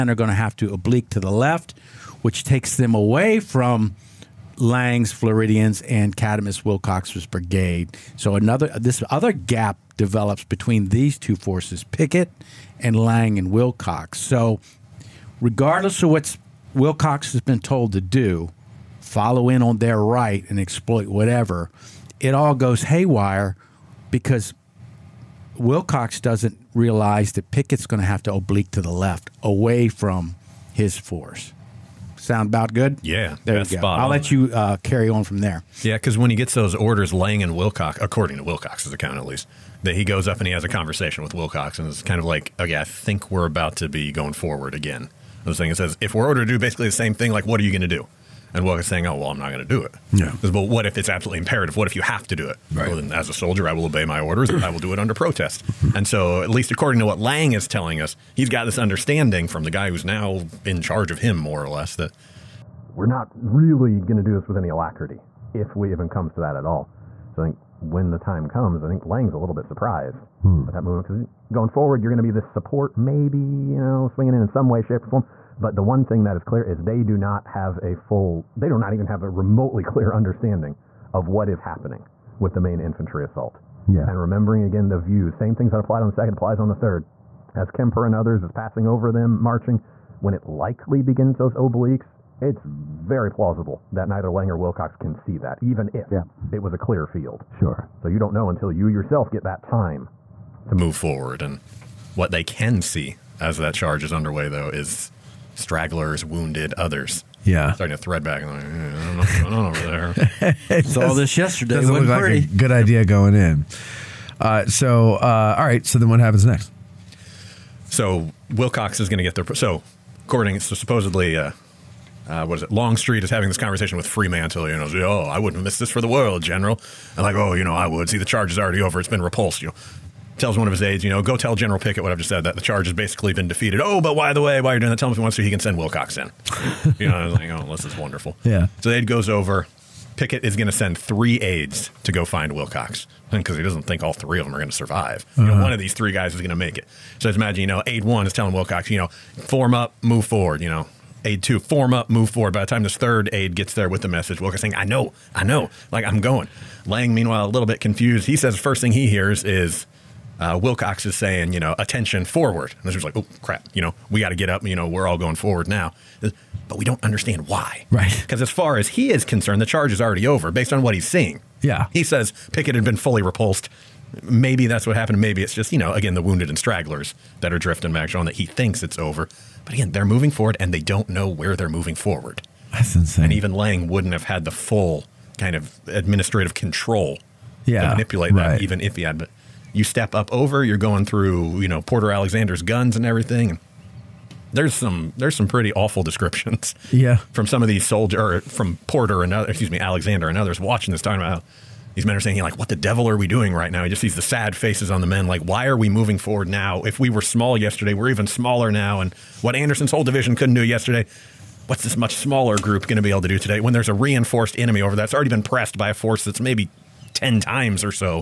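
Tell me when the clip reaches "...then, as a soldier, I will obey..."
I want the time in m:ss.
0:52.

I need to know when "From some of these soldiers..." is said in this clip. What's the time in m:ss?
3:17.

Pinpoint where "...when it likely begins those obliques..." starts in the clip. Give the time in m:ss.
1:30.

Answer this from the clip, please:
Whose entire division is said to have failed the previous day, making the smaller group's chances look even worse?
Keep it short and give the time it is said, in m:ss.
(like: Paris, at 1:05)
Anderson, at 3:29.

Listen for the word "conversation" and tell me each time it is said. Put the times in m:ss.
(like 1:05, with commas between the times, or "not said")
0:40, 2:03.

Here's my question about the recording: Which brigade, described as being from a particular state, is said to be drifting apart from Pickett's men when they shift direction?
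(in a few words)
Lang's Floridians.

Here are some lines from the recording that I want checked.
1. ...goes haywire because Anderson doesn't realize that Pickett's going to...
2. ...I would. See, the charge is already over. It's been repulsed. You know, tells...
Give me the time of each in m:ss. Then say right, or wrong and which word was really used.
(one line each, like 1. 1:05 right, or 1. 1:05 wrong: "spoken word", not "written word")
1. 0:22 wrong: "Wilcox", not "Anderson"
2. 2:07 right.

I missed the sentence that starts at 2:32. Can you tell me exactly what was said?
By the time this third aid gets there with the message, Wilcox's saying, I know, I know, like I'm going.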